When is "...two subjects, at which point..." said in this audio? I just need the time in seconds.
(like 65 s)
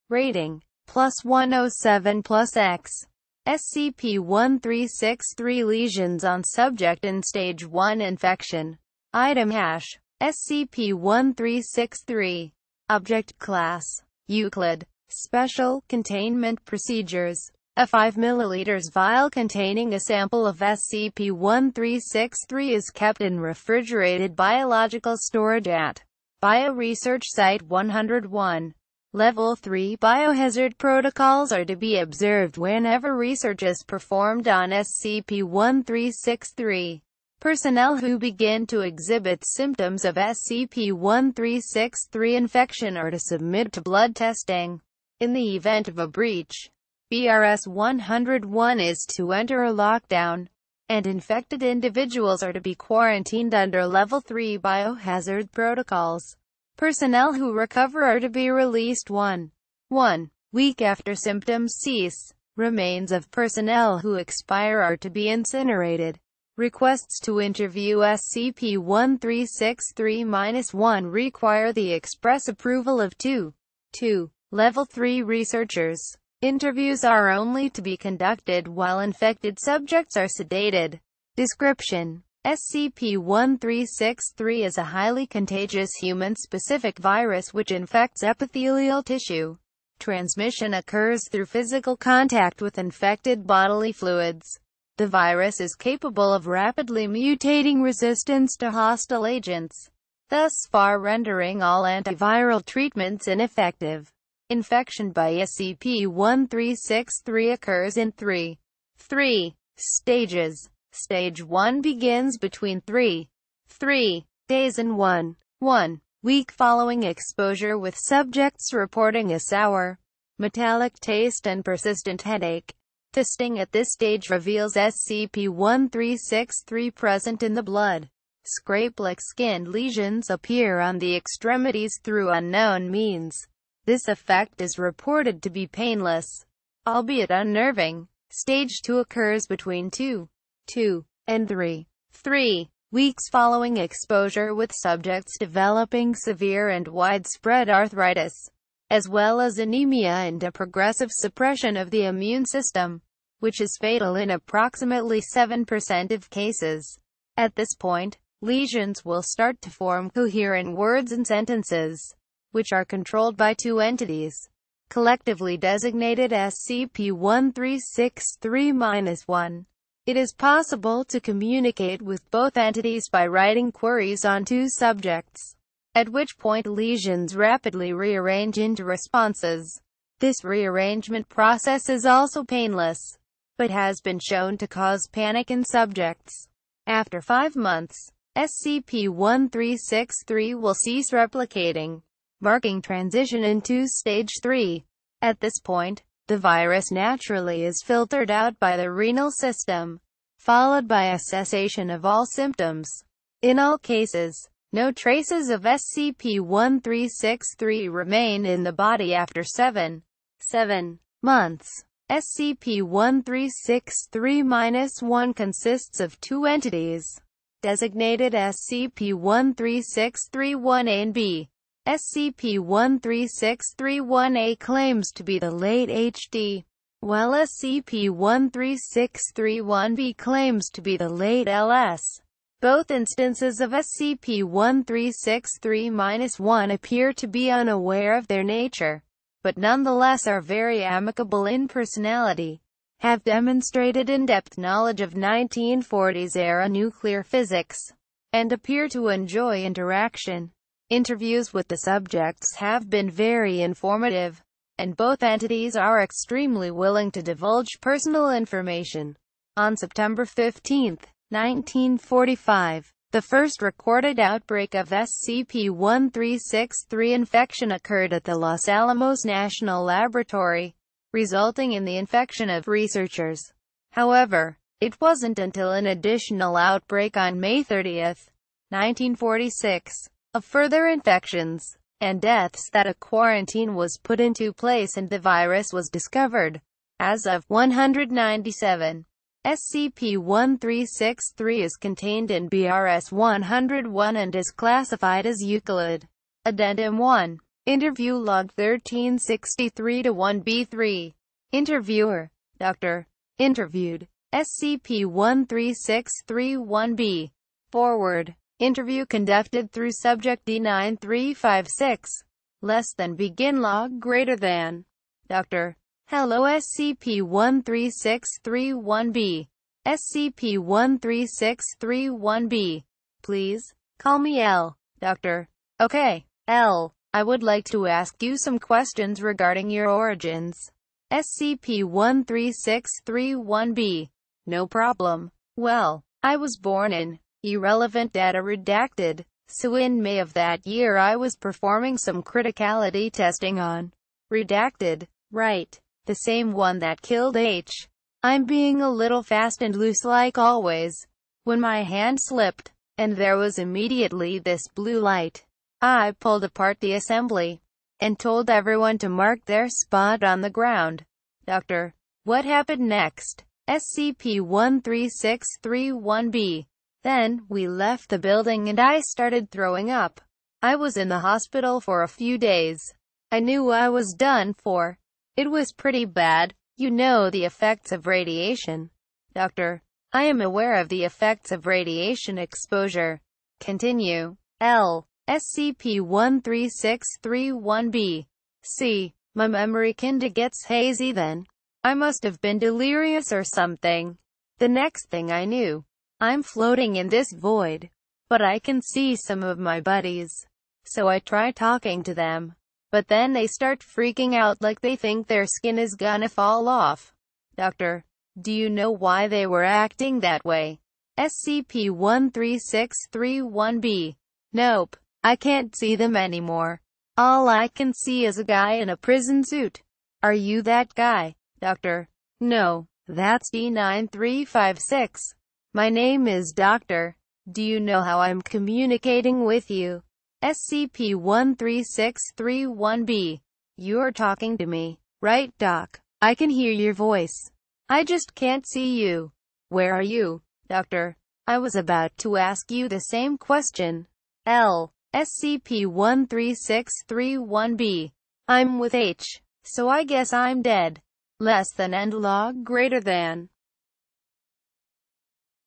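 174 s.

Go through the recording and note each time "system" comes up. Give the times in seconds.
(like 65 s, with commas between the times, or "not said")
152 s, 199 s.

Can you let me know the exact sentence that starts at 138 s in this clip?
Stage 2 occurs between 2, 2, and 3.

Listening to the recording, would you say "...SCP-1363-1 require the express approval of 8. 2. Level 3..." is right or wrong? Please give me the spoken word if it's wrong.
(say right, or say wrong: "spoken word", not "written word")
wrong: "2", not "8".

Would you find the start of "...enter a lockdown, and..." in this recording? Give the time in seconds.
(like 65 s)
49 s.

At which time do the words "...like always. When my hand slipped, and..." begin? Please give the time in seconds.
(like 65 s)
350 s.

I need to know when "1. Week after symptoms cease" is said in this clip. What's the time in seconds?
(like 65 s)
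59 s.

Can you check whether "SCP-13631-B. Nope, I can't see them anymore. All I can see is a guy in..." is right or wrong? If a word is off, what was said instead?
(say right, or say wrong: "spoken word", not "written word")
right.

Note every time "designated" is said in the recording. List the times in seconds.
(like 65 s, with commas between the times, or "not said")
165 s, 217 s.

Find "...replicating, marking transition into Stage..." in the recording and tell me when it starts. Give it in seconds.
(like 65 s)
191 s.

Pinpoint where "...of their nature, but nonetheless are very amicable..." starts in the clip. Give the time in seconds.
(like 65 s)
238 s.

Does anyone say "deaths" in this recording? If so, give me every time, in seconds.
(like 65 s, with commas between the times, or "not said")
282 s.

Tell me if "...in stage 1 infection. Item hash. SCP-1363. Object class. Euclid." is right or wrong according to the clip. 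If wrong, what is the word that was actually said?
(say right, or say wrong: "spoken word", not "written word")
right.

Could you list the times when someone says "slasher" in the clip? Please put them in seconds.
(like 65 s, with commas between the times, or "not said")
not said.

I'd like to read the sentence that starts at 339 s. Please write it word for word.
So in May of that year I was performing some criticality testing on redacted.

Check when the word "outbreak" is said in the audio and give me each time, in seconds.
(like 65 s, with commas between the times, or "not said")
264 s, 276 s.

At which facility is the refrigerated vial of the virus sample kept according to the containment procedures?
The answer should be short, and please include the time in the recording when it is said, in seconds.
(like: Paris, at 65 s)
Bioresearch Site 101, at 26 s.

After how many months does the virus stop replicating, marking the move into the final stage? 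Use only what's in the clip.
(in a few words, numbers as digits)
5.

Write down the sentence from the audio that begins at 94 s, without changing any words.
The virus is capable of rapidly mutating resistance to hostile agents, thus far rendering all antiviral treatments ineffective.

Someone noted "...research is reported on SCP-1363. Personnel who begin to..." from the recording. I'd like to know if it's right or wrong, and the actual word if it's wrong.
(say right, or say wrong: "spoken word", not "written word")
wrong: "performed", not "reported".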